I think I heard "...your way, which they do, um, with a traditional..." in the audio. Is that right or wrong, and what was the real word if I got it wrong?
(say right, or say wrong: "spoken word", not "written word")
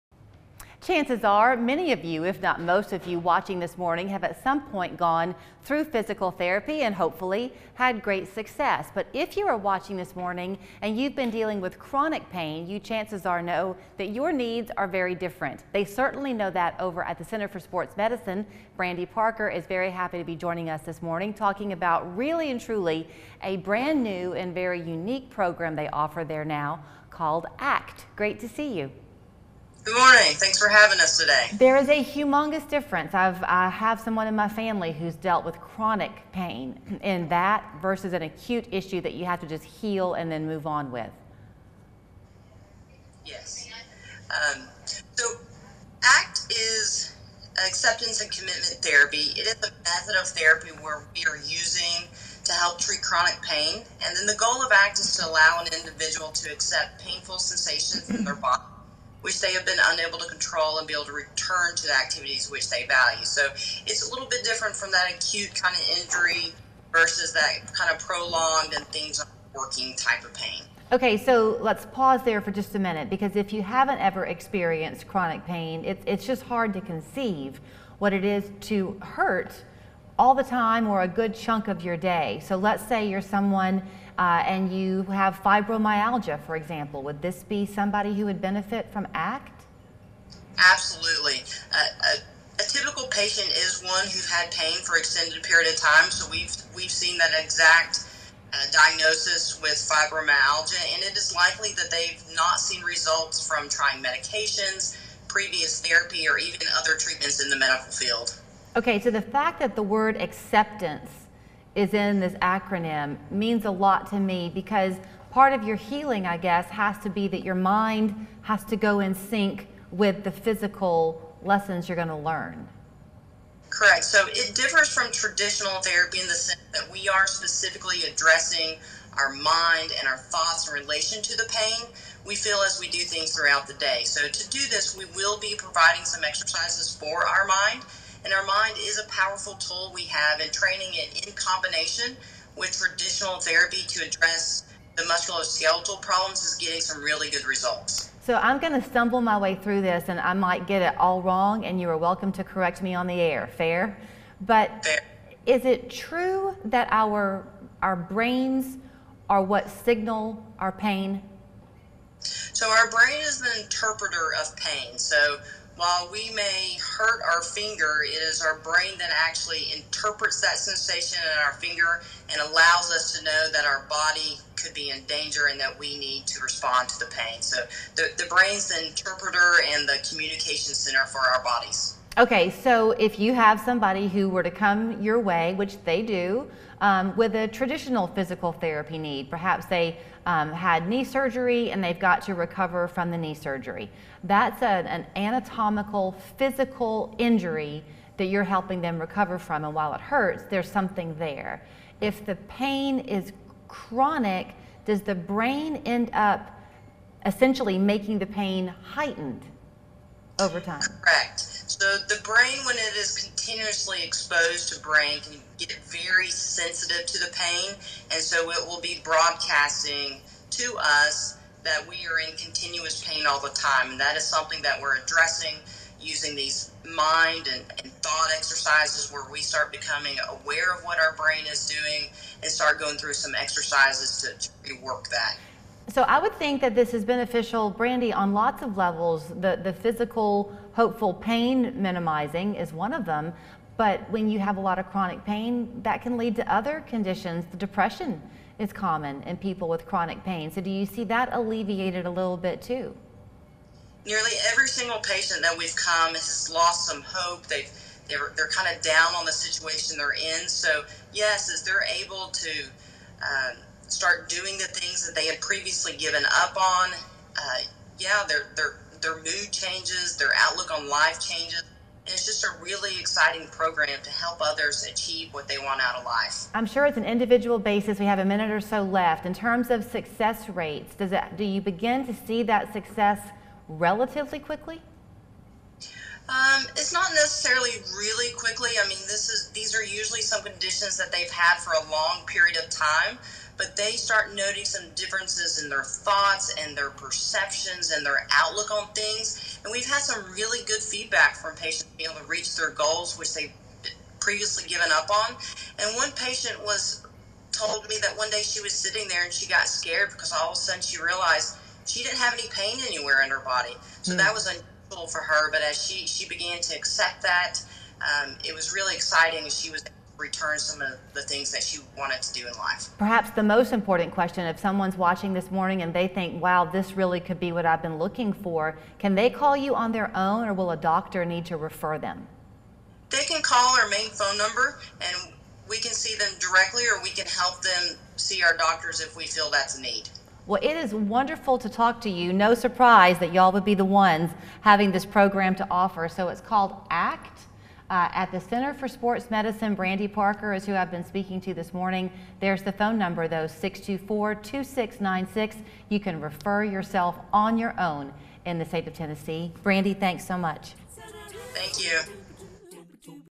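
right.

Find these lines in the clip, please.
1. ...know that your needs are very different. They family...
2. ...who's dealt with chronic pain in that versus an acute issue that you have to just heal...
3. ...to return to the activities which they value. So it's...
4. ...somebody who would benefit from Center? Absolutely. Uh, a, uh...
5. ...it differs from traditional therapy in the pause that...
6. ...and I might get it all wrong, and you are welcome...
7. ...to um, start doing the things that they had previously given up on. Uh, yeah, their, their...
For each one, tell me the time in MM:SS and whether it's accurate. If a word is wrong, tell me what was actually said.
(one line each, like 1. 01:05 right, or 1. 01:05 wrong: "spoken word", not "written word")
1. 00:13 wrong: "certainly", not "family"
2. 00:34 right
3. 01:01 right
4. 01:27 wrong: "ACT", not "Center"
5. 02:04 wrong: "sense", not "pause"
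6. 02:30 right
7. 04:22 right.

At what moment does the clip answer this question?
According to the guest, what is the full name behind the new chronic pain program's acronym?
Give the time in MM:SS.
00:47.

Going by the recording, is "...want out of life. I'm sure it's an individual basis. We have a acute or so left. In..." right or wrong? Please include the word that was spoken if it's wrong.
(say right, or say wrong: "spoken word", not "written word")
wrong: "minute", not "acute".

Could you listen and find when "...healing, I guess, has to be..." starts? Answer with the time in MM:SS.
01:55.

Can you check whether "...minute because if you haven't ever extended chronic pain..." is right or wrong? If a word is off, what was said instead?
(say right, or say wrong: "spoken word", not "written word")
wrong: "experienced", not "extended".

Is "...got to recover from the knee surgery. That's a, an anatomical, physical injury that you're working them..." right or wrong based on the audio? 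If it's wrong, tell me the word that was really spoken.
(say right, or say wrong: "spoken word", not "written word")
wrong: "helping", not "working".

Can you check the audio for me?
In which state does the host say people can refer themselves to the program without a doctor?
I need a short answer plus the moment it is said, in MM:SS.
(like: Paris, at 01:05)
Tennessee, at 05:58.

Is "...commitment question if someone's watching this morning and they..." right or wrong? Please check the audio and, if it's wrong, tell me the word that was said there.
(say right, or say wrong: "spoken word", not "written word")
wrong: "important", not "commitment".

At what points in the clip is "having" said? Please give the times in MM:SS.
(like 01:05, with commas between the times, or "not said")
00:30, 05:44.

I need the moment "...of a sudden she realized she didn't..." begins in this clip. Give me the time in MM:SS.
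05:10.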